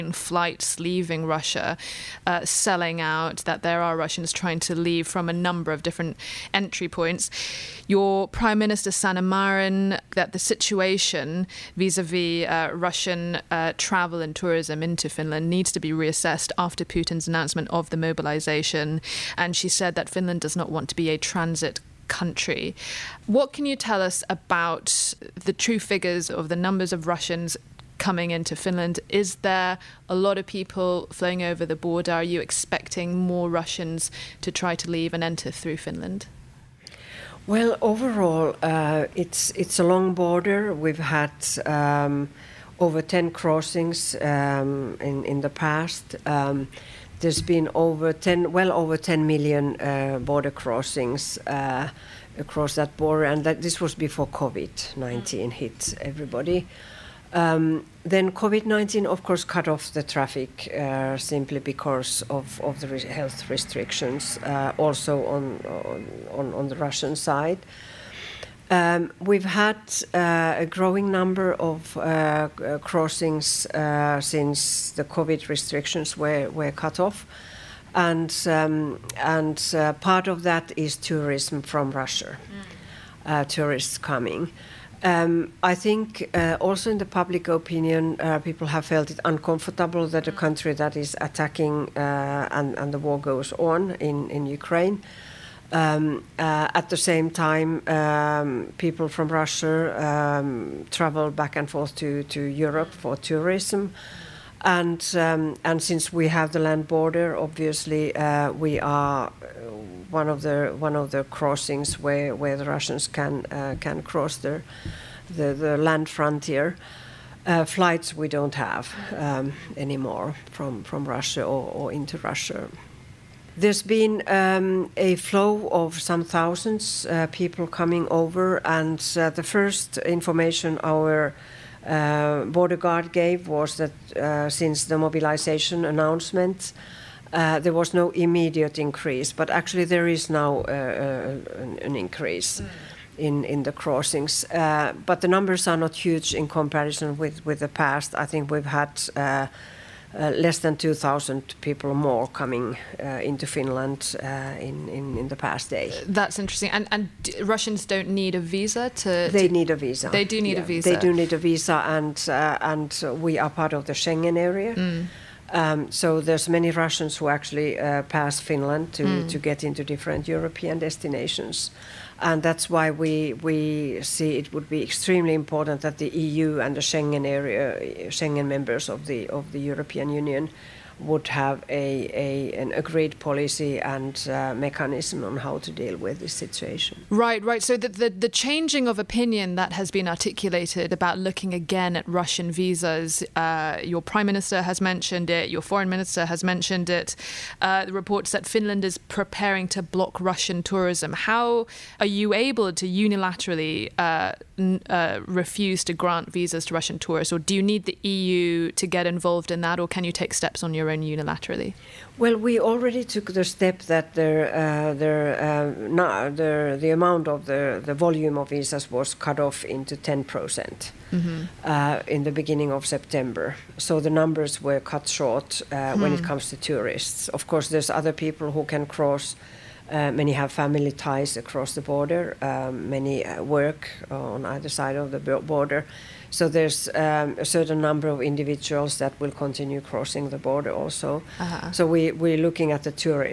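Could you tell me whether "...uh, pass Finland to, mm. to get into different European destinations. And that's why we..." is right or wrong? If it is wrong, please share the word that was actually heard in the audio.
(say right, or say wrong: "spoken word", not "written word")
right.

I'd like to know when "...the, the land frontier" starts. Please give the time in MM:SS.
01:54.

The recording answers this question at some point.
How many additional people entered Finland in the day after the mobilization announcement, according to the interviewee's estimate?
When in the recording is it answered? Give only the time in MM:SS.
02:30.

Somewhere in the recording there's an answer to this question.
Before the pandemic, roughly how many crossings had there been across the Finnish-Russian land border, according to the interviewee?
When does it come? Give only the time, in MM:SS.
00:48.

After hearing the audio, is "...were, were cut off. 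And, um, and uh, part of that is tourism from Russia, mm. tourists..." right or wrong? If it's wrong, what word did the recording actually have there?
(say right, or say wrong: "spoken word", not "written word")
right.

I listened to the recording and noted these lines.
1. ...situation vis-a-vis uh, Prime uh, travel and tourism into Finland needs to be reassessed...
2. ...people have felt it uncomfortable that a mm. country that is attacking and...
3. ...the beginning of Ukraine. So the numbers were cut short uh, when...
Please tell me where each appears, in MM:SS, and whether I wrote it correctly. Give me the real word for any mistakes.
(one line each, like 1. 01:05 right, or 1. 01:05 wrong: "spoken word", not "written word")
1. 00:10 wrong: "Russian", not "Prime"
2. 01:28 right
3. 03:42 wrong: "September", not "Ukraine".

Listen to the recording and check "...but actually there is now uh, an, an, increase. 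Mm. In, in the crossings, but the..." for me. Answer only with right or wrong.
right.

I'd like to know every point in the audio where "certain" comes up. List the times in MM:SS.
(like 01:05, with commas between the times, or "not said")
03:57.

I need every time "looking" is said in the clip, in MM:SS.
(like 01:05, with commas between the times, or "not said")
03:11, 04:02.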